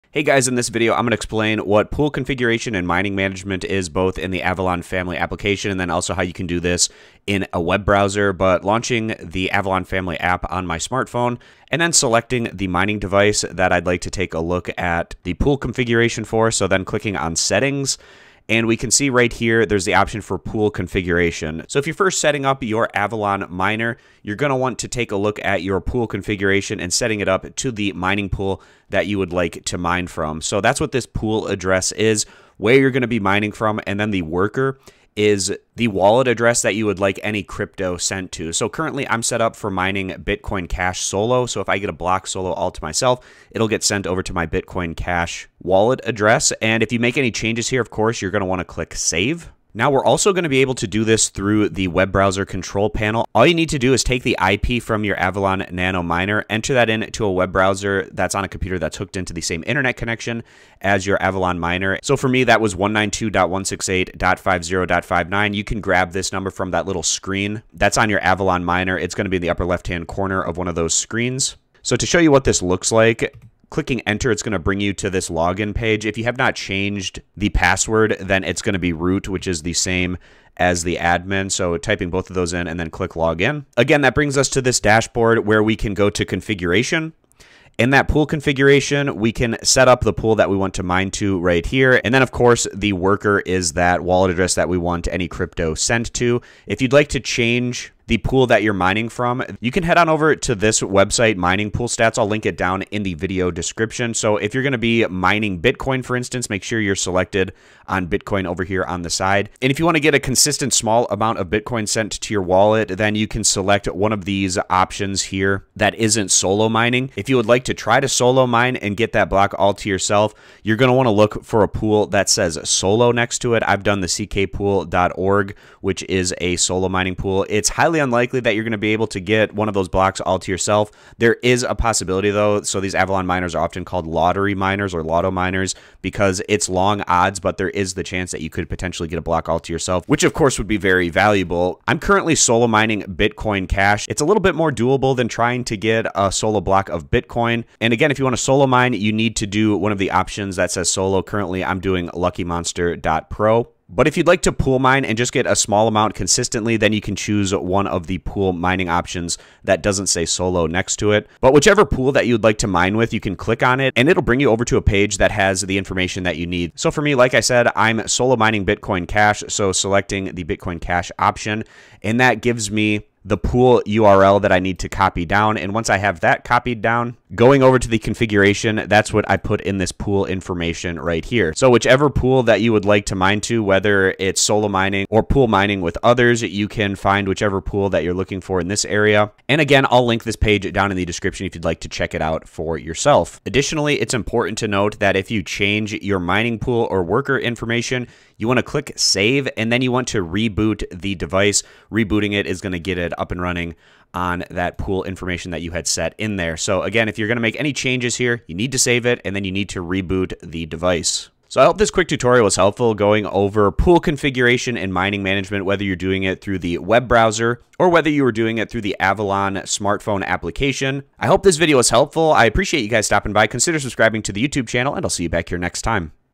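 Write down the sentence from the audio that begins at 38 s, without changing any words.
So currently I'm set up for mining Bitcoin Cash solo.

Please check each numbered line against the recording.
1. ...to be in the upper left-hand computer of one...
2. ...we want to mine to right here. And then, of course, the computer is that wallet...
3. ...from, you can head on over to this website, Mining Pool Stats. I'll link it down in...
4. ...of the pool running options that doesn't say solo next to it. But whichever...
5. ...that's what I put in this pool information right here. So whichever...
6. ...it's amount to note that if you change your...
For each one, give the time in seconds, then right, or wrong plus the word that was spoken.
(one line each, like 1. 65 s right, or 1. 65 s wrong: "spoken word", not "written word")
1. 69 s wrong: "corner", not "computer"
2. 90 s wrong: "worker", not "computer"
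3. 99 s right
4. 157 s wrong: "mining", not "running"
5. 178 s right
6. 194 s wrong: "important", not "amount".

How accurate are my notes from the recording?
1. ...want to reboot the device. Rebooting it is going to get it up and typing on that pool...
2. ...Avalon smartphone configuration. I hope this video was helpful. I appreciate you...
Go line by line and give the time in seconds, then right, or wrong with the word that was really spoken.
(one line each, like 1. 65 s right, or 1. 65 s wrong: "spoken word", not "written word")
1. 199 s wrong: "running", not "typing"
2. 218 s wrong: "application", not "configuration".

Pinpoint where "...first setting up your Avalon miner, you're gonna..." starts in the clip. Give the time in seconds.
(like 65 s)
21 s.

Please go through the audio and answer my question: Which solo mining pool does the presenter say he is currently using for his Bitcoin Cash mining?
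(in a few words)
luckymonster.pro.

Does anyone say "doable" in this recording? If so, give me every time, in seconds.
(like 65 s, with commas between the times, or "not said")
144 s.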